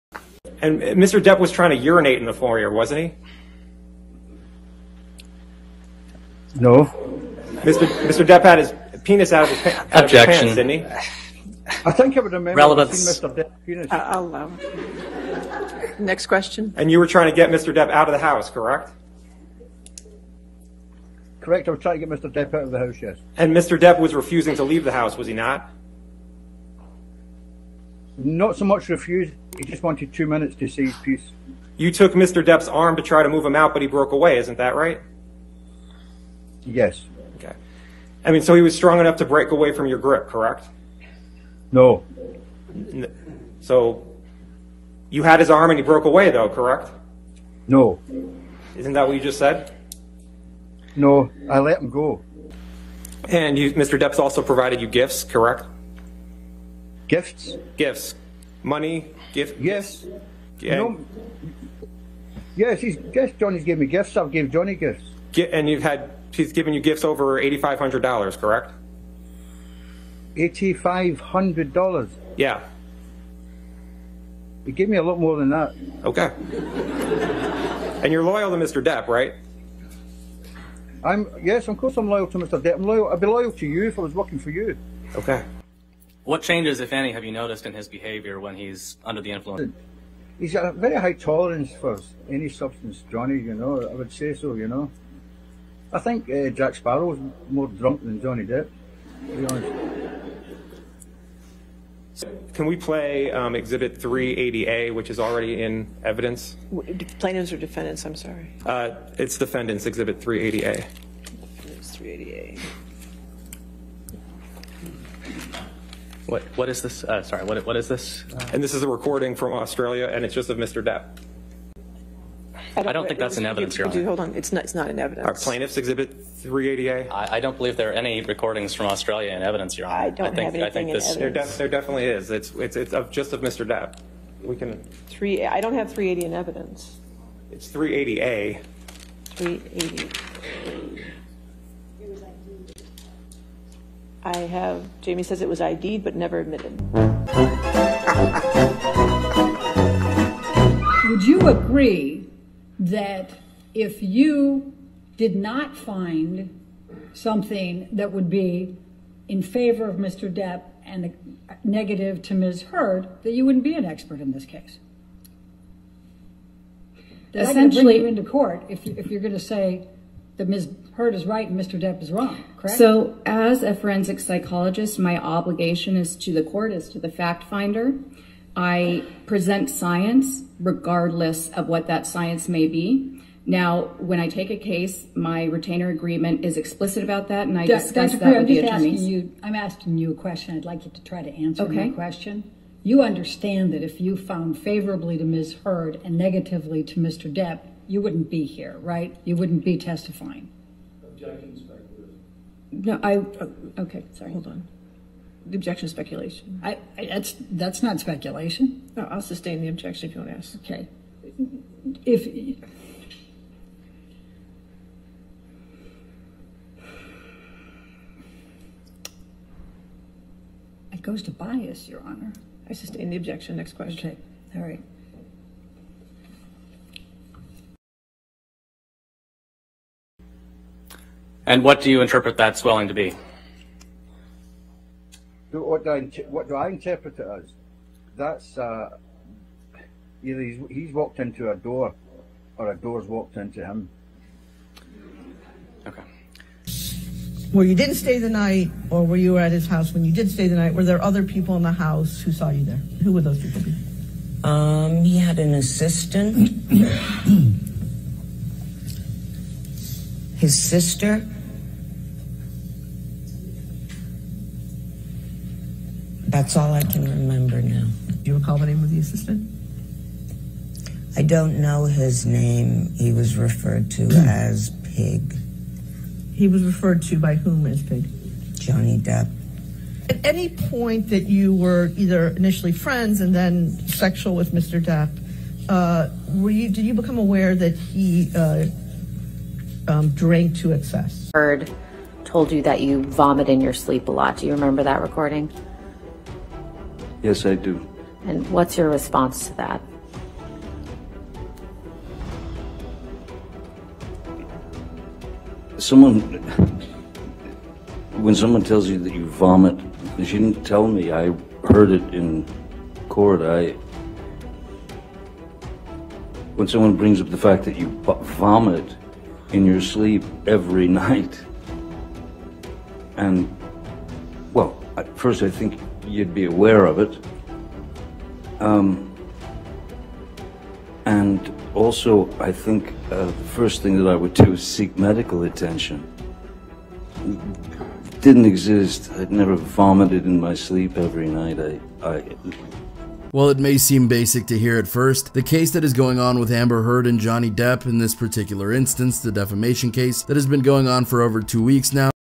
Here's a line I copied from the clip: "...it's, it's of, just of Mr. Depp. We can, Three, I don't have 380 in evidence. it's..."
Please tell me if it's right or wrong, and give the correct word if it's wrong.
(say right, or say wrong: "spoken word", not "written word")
right.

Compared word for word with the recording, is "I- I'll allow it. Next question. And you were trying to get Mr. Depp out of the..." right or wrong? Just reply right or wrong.
right.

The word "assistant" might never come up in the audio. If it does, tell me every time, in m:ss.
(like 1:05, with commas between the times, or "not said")
4:15, 4:28.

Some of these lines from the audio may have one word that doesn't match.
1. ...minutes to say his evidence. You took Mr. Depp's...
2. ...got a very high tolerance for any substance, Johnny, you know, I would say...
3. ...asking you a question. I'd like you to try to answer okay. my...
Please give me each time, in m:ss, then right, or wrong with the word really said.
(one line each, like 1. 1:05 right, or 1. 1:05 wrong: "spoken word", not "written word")
1. 0:30 wrong: "piece", not "evidence"
2. 1:30 right
3. 3:09 right.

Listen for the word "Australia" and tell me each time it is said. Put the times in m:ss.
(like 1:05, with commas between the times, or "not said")
1:59, 2:08.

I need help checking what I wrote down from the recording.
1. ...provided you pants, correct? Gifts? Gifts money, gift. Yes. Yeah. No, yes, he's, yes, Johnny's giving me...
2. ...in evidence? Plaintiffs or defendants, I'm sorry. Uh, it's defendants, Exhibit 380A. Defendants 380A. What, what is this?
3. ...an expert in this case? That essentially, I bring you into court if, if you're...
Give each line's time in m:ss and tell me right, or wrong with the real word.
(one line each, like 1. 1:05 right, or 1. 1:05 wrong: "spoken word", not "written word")
1. 0:54 wrong: "gifts", not "pants"
2. 1:45 right
3. 2:43 right.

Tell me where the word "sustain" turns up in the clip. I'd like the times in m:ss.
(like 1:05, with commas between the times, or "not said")
3:29, 3:42.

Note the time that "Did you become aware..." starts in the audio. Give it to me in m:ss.
4:46.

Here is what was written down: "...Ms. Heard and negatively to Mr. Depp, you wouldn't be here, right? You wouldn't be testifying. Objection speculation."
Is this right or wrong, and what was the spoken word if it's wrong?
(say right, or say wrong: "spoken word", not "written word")
right.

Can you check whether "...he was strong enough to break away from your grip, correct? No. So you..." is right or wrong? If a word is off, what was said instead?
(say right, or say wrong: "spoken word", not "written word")
right.